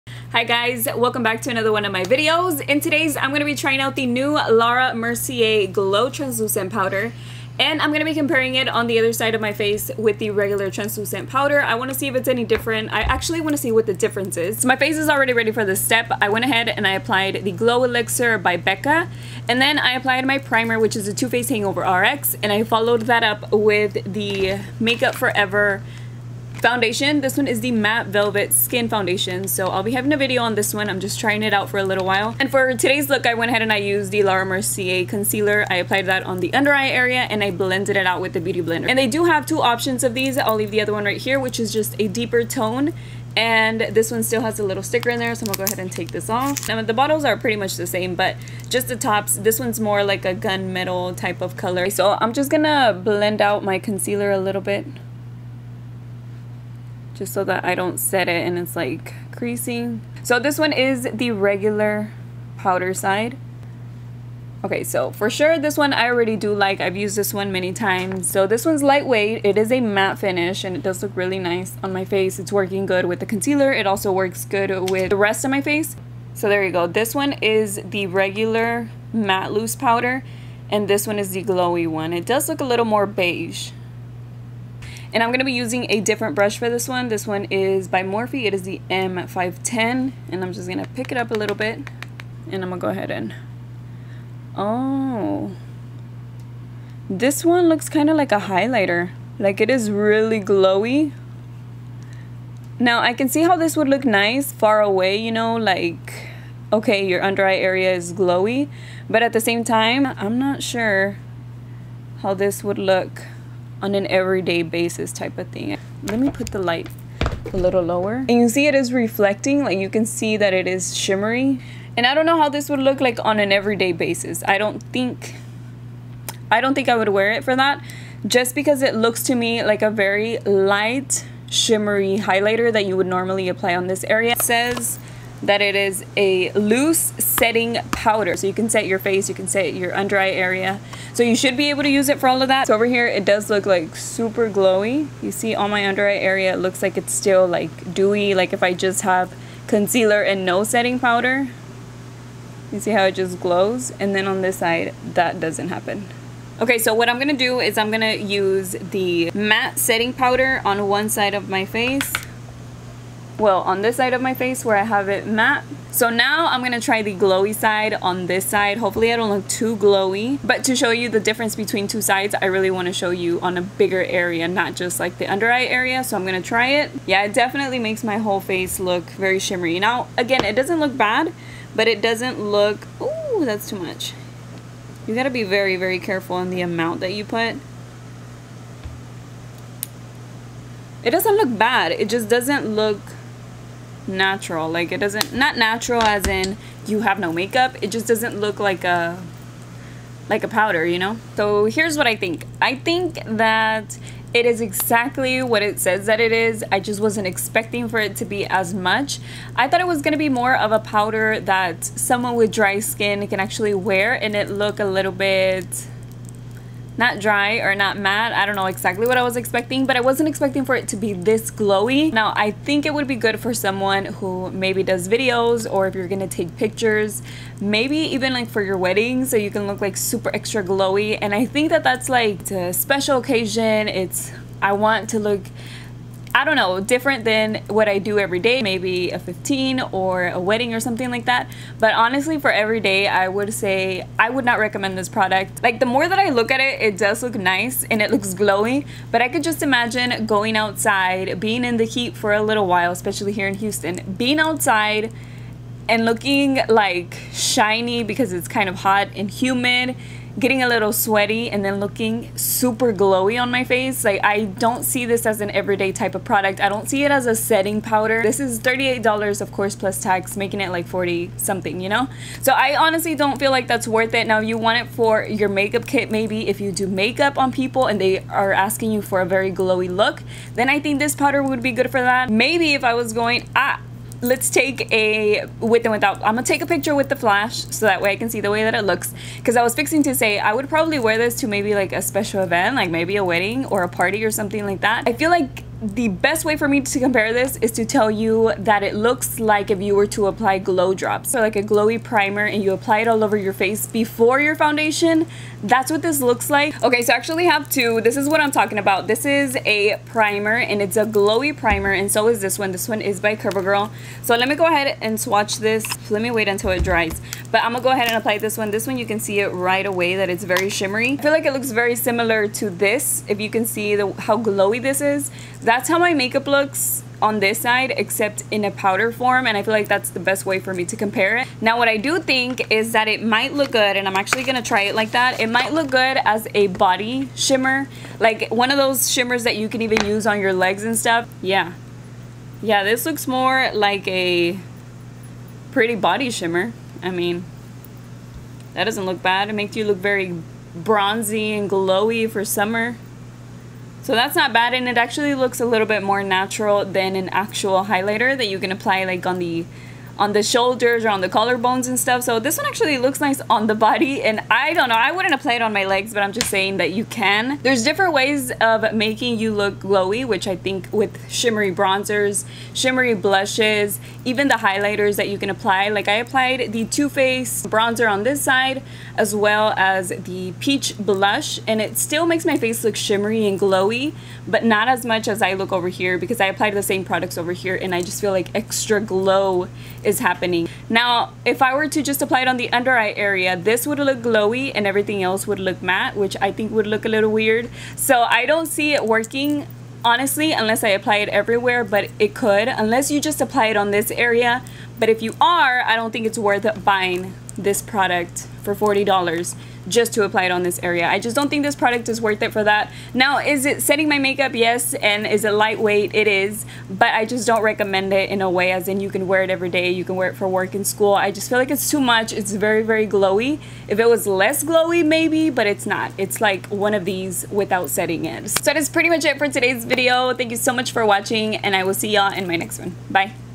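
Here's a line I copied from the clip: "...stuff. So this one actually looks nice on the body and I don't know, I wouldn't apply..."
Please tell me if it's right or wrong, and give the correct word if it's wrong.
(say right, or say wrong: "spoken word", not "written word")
right.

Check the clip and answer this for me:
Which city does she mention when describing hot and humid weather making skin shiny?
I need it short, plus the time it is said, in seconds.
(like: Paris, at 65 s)
Houston, at 253 s.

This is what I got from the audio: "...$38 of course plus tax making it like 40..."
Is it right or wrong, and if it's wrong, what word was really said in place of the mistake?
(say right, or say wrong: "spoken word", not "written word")
right.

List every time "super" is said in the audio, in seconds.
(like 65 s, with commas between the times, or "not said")
143 s, 229 s, 262 s.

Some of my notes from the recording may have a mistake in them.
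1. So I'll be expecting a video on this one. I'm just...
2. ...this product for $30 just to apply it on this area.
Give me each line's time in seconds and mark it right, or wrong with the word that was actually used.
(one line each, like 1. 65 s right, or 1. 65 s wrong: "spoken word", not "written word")
1. 29 s wrong: "having", not "expecting"
2. 407 s wrong: "40", not "30".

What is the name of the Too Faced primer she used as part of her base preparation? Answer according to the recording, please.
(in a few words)
Hangover RX.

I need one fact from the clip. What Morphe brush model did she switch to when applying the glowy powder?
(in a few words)
M510.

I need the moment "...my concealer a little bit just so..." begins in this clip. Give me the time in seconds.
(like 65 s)
53 s.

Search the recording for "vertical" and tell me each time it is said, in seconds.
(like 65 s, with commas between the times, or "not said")
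not said.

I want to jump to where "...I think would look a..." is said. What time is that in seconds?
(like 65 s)
396 s.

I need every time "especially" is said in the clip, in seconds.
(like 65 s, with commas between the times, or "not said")
252 s.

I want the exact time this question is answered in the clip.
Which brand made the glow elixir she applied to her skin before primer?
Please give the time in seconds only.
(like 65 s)
18 s.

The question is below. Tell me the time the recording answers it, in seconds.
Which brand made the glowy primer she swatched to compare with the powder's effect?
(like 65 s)
313 s.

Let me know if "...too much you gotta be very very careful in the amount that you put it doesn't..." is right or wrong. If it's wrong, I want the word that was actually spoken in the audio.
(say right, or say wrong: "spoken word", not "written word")
right.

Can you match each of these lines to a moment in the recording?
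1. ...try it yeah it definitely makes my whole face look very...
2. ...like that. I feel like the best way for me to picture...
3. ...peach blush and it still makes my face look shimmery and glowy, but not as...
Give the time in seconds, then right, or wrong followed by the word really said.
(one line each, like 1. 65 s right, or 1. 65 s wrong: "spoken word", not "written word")
1. 176 s right
2. 294 s wrong: "compare", not "picture"
3. 380 s right.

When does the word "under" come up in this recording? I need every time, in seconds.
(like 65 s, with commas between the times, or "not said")
36 s, 107 s, 139 s, 145 s, 175 s, 392 s.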